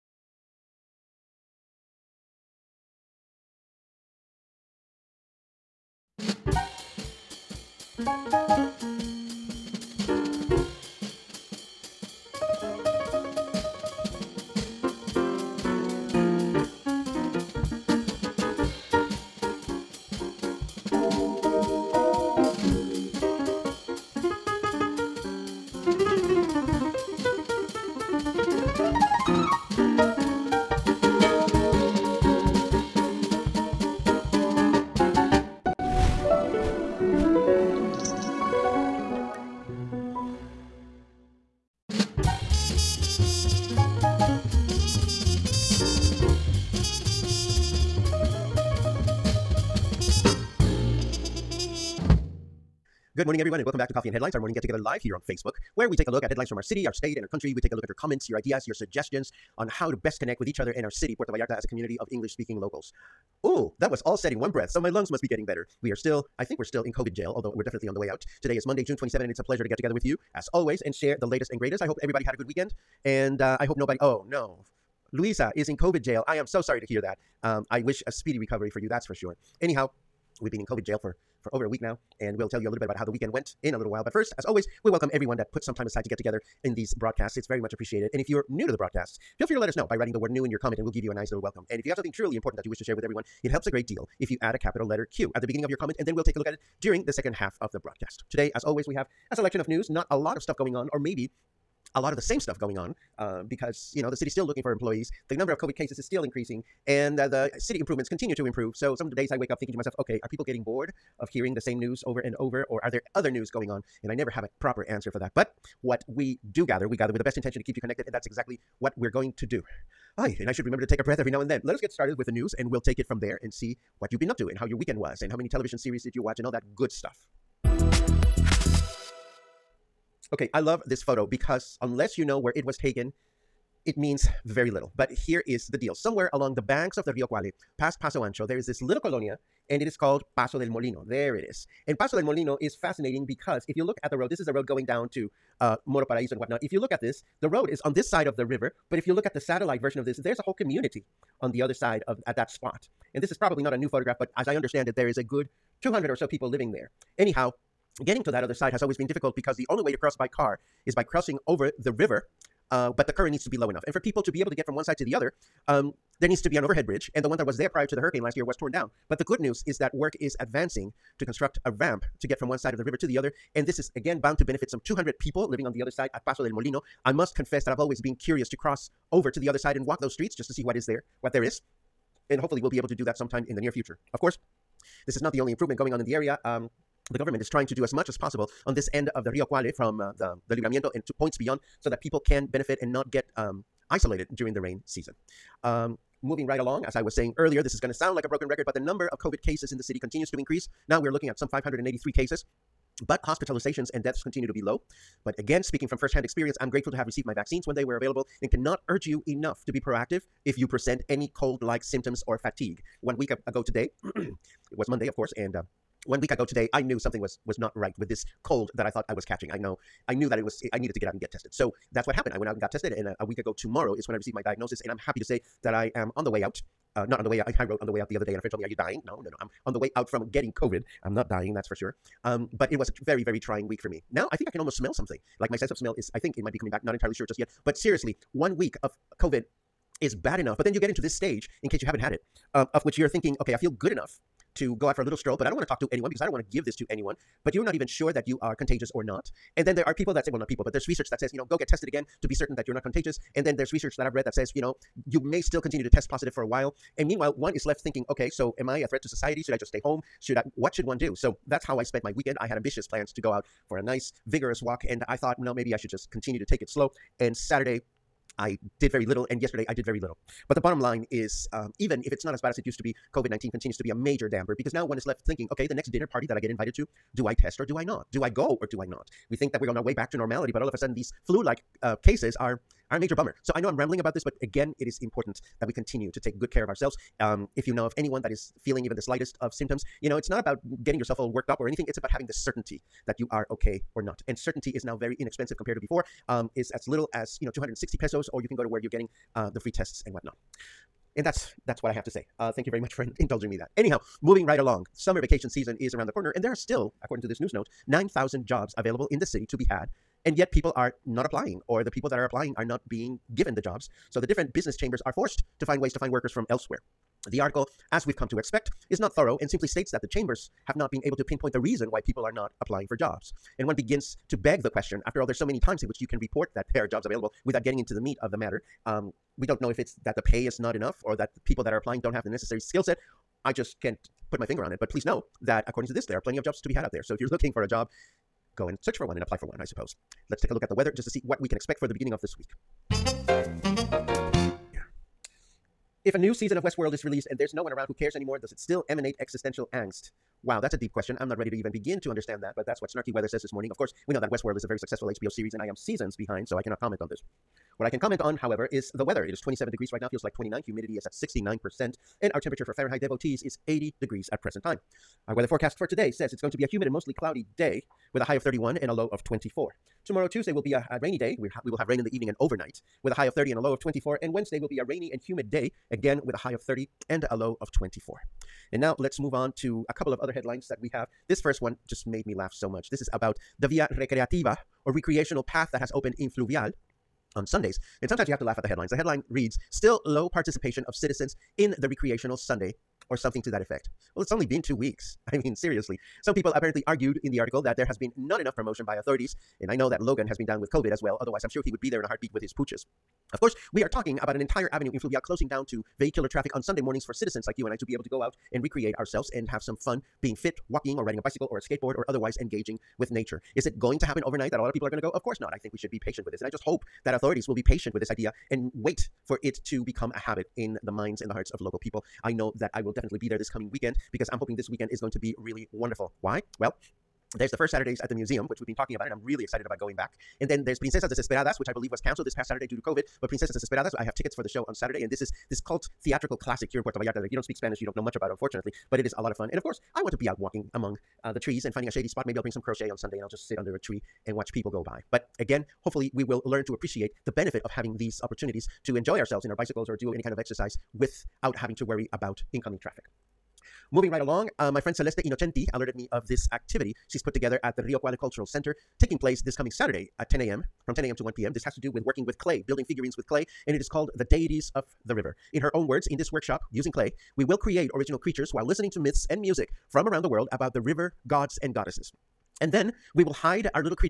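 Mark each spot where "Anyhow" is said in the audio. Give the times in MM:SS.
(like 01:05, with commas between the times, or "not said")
01:19, 02:37, 05:03.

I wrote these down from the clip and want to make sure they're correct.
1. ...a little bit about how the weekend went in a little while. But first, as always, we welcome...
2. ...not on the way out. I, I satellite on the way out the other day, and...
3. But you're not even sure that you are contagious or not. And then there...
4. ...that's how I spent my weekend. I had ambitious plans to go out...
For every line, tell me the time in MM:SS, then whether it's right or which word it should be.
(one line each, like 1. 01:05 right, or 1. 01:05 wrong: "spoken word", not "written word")
1. 01:22 right
2. 03:47 wrong: "wrote", not "satellite"
3. 04:07 right
4. 04:21 right.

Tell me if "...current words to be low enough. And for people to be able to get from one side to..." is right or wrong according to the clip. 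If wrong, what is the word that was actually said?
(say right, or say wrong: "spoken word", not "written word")
wrong: "needs", not "words".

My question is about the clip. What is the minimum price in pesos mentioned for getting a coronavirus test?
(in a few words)
260 pesos.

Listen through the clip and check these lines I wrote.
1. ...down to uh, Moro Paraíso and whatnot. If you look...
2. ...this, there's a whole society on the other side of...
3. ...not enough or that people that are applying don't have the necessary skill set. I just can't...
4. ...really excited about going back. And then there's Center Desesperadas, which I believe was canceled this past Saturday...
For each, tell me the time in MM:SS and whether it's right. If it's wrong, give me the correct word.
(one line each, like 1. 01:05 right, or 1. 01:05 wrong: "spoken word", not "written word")
1. 02:24 right
2. 02:30 wrong: "community", not "society"
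3. 05:30 right
4. 07:09 wrong: "Princesas", not "Center".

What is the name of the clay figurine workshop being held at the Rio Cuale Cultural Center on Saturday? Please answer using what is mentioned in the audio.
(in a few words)
The Deities of the River.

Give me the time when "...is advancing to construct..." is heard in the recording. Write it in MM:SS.
02:50.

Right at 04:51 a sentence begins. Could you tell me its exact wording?
It's about having the certainty that you are okay or not.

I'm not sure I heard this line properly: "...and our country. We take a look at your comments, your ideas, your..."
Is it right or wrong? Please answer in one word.
right.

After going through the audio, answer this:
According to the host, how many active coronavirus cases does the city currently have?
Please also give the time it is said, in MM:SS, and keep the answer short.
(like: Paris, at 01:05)
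583, at 03:21.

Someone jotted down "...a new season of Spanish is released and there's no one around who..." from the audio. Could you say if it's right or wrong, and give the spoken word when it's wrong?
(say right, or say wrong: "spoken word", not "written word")
wrong: "Westworld", not "Spanish".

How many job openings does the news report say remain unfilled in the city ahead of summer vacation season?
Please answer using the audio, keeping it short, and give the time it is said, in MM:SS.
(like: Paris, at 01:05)
9,000, at 05:07.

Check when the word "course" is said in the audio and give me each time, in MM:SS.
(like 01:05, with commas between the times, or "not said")
03:04, 03:35, 05:53, 06:43, 06:55, 07:19.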